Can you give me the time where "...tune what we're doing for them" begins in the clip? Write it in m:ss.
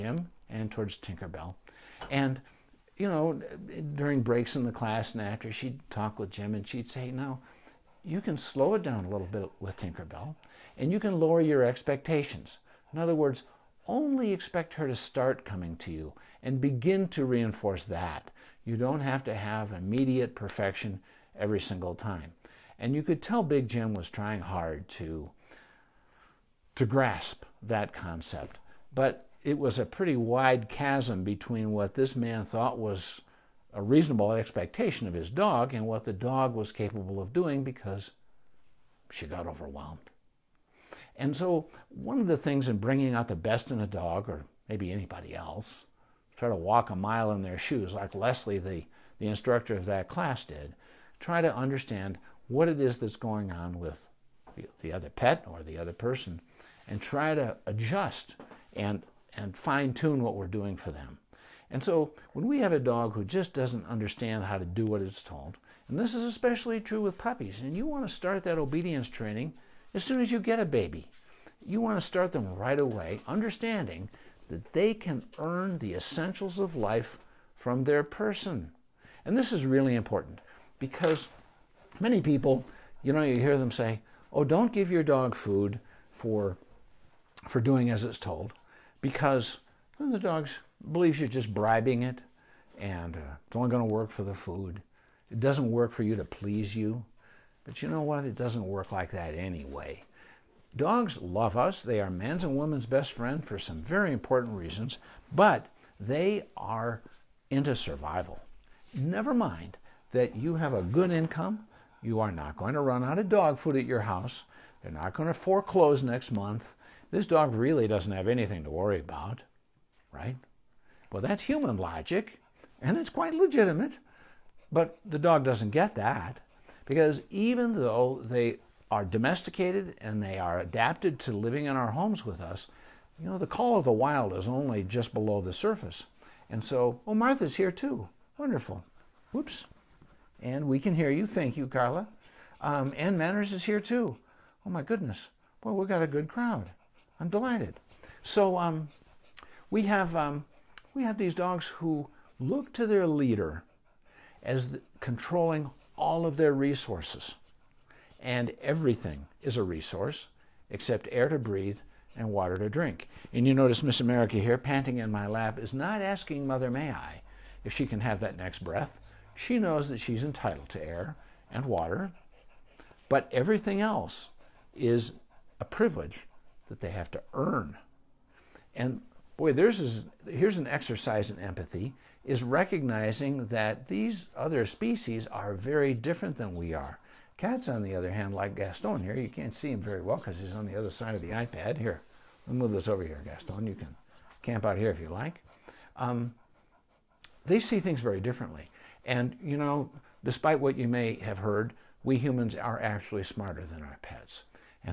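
0:59.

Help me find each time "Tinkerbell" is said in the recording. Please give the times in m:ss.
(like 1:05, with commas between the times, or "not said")
0:00, 0:09.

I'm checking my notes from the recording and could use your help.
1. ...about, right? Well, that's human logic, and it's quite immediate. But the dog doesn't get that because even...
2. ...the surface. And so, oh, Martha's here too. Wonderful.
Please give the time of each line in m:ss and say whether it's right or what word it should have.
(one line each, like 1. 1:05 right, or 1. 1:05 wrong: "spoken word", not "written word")
1. 1:58 wrong: "legitimate", not "immediate"
2. 2:15 right.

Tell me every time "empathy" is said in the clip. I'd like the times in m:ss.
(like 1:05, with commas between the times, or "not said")
3:01.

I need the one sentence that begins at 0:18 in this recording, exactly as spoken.
You don't have to have immediate perfection every single time.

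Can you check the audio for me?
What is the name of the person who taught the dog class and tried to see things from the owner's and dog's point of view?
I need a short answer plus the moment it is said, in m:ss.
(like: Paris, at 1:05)
Leslie, at 0:48.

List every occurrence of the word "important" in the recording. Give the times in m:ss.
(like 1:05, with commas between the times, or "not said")
1:19, 1:44.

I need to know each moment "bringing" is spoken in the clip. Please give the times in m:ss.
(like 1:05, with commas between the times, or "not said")
0:42.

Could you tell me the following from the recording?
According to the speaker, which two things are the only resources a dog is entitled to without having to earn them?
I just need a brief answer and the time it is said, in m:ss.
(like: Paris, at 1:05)
Air and water, at 2:41.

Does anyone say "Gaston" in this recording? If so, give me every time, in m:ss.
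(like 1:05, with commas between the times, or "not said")
3:08, 3:13.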